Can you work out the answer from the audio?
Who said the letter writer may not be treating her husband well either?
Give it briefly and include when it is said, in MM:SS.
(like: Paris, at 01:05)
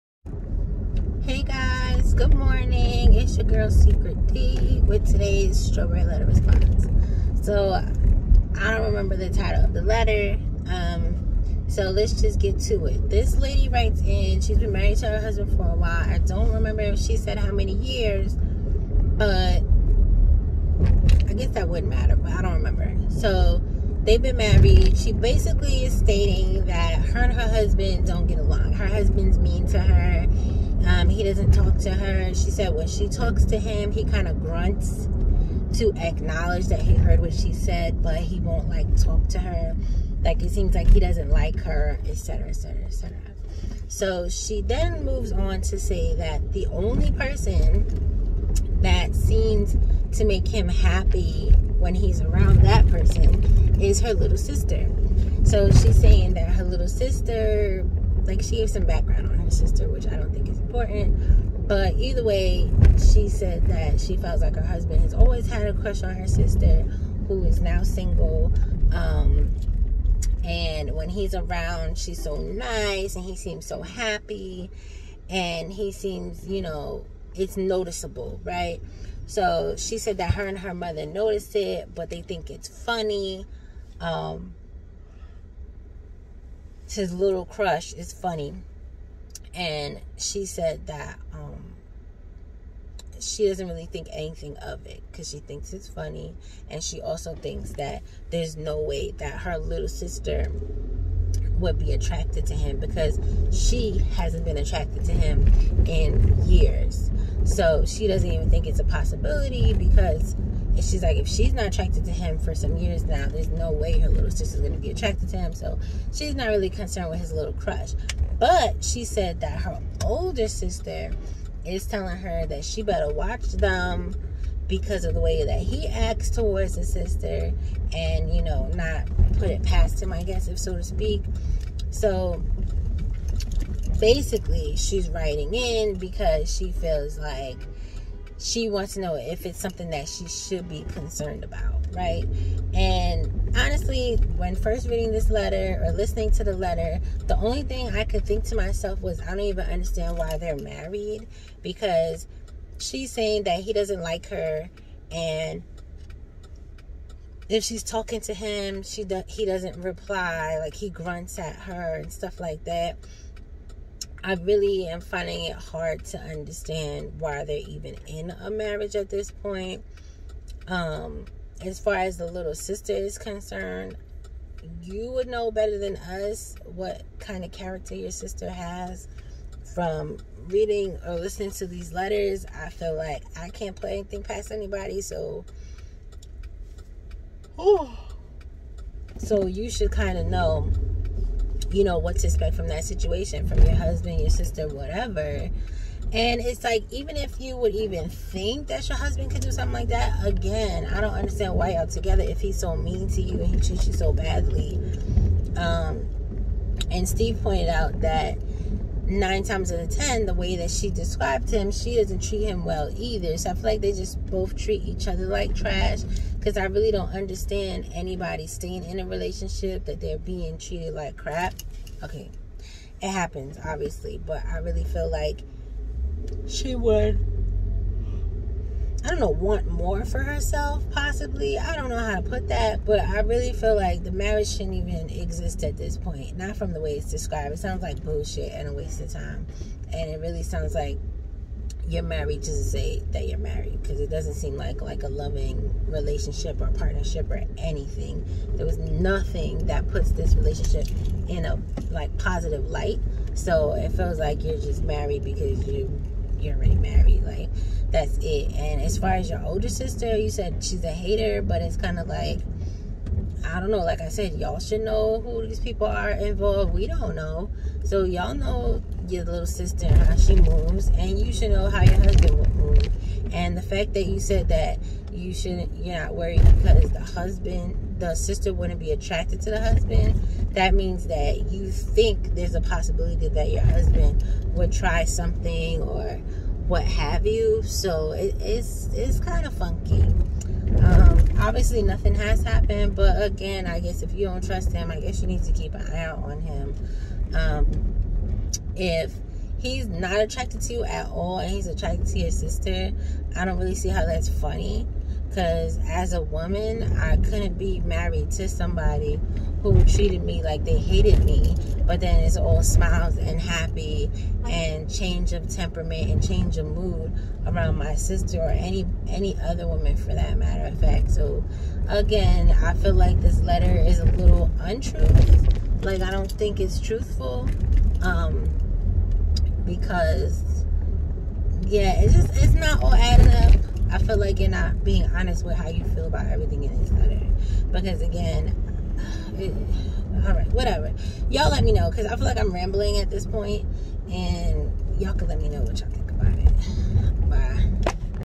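Steve, at 03:27.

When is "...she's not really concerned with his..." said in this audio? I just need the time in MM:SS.
01:56.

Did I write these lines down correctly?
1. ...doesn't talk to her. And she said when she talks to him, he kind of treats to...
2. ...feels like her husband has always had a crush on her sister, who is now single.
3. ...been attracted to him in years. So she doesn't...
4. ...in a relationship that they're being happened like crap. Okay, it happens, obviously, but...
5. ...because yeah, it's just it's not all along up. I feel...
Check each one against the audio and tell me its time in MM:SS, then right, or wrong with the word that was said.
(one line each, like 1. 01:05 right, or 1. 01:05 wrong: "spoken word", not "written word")
1. 00:31 wrong: "grunts", not "treats"
2. 01:04 right
3. 01:44 right
4. 03:38 wrong: "treated", not "happened"
5. 05:29 wrong: "adding", not "along".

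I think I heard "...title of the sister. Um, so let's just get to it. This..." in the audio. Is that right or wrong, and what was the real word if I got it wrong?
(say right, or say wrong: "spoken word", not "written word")
wrong: "letter", not "sister".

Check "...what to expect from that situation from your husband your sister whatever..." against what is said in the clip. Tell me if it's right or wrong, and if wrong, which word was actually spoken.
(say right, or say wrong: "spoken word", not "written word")
right.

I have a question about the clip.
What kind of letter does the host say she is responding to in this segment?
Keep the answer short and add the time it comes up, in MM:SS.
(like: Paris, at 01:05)
strawberry letter, at 00:05.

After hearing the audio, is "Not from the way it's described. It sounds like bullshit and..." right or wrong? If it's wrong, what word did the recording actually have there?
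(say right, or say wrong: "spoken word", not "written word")
right.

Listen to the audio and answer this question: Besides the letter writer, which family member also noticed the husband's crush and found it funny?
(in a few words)
her mother.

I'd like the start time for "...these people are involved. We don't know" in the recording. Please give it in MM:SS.
04:25.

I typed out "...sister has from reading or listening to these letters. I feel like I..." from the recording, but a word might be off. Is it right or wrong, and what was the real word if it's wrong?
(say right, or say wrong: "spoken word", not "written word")
right.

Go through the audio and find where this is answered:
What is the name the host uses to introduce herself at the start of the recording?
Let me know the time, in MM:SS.
00:03.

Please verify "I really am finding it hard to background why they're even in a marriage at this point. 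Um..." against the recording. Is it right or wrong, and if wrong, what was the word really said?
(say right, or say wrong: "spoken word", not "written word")
wrong: "understand", not "background".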